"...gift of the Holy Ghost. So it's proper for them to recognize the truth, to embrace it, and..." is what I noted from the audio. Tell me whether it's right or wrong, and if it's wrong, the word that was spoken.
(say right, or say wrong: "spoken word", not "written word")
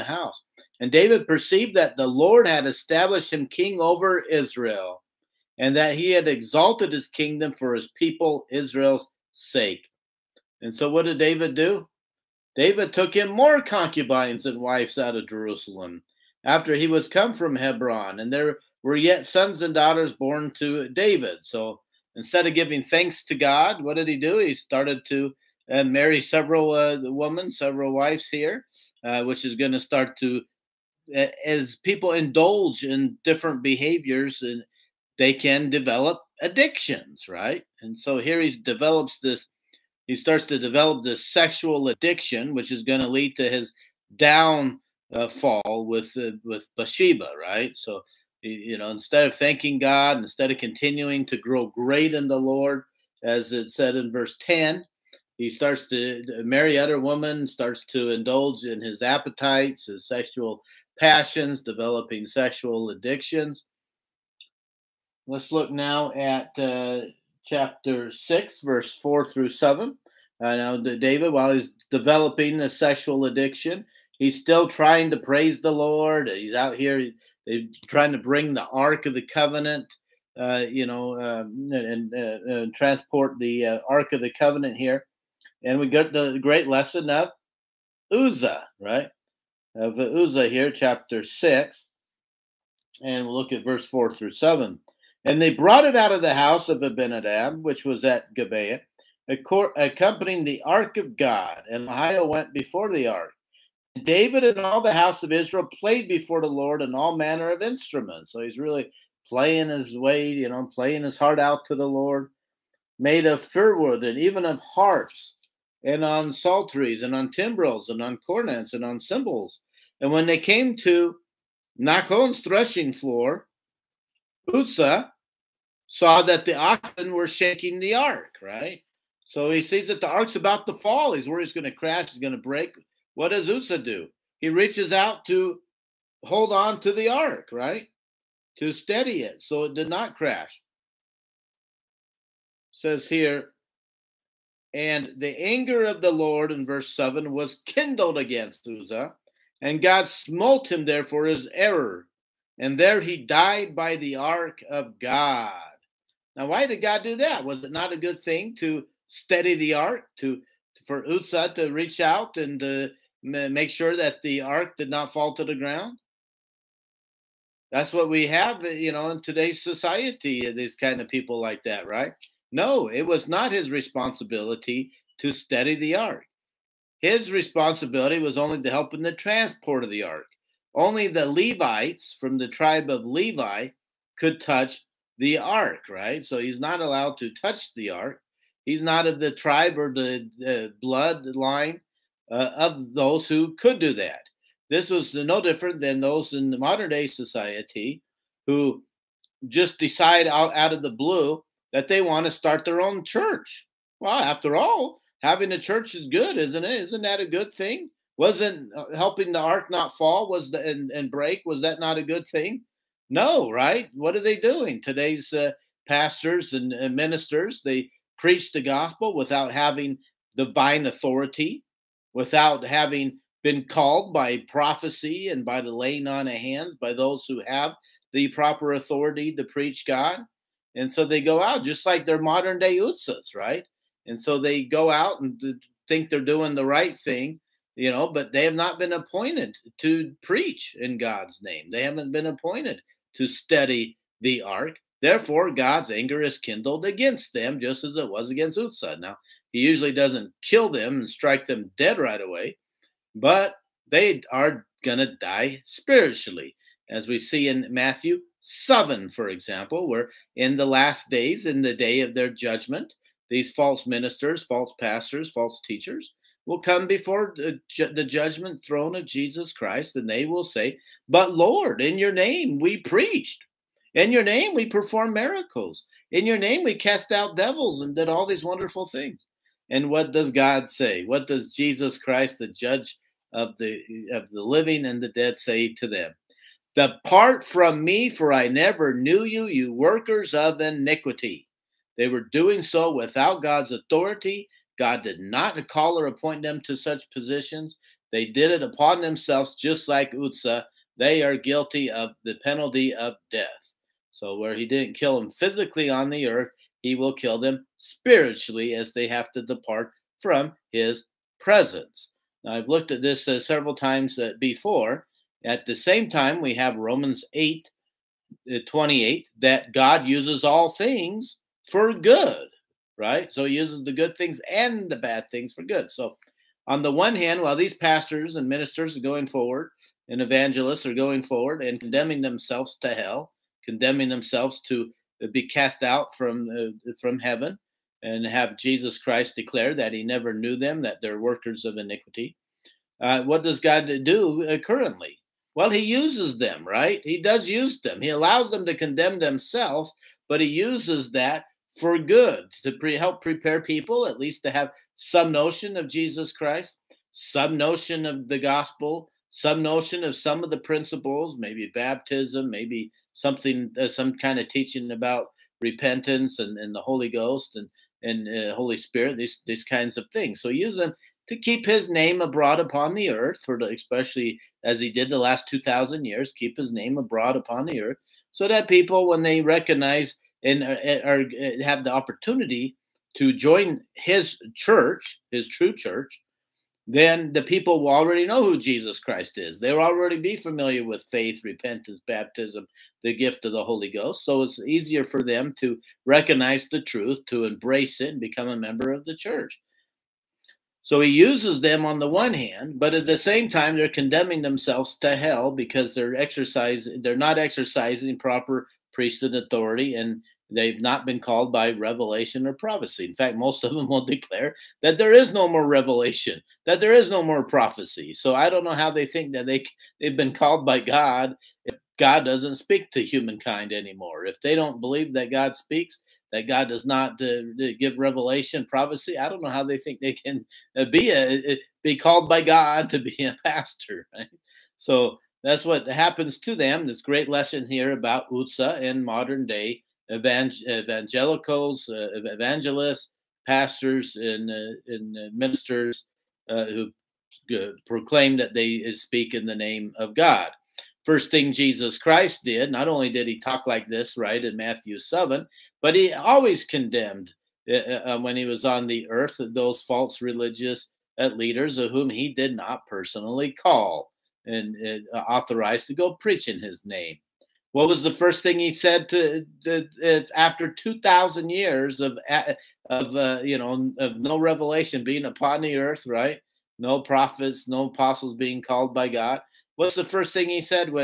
wrong: "easier", not "proper".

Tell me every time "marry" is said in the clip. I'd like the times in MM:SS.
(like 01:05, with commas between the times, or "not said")
00:25, 00:56.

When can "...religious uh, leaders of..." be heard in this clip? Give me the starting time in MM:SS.
07:40.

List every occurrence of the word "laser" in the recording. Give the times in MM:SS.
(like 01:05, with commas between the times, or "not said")
not said.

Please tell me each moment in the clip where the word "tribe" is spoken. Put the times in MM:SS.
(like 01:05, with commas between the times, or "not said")
03:02, 03:09.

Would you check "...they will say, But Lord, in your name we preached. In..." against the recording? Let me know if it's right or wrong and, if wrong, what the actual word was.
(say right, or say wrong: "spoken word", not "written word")
right.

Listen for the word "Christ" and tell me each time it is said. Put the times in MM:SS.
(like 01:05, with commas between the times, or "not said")
04:29, 04:41, 05:38, 05:56, 06:29, 07:31.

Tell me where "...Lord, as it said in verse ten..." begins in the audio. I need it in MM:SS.
00:52.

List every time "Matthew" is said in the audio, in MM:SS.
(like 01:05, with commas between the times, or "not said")
04:17, 07:34.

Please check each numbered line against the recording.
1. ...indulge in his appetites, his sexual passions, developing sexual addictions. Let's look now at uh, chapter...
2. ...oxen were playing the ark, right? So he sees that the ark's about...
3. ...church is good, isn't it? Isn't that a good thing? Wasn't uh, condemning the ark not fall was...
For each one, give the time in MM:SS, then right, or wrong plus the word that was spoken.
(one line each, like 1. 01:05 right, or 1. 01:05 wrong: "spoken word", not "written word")
1. 00:58 right
2. 02:06 wrong: "shaking", not "playing"
3. 03:25 wrong: "helping", not "condemning".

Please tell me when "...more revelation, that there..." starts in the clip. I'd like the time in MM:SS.
06:55.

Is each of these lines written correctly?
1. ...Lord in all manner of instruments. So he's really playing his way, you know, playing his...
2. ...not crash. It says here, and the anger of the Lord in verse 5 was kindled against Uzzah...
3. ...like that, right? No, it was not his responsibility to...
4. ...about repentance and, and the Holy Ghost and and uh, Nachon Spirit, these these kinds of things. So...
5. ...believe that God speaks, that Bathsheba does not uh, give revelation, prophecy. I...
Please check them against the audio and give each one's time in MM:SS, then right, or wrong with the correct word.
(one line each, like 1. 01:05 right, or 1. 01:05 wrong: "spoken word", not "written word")
1. 01:46 right
2. 02:19 wrong: "7", not "5"
3. 02:51 right
4. 06:04 wrong: "Holy", not "Nachon"
5. 07:04 wrong: "God", not "Bathsheba".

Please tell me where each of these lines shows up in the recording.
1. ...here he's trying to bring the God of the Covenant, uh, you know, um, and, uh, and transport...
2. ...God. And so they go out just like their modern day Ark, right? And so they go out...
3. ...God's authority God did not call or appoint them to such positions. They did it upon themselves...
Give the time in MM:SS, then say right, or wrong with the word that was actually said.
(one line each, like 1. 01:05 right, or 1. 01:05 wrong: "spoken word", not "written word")
1. 01:16 wrong: "Ark", not "God"
2. 03:49 wrong: "Uzzahs", not "Ark"
3. 04:53 right.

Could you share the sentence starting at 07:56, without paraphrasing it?
No prophets, no apostles being called by God.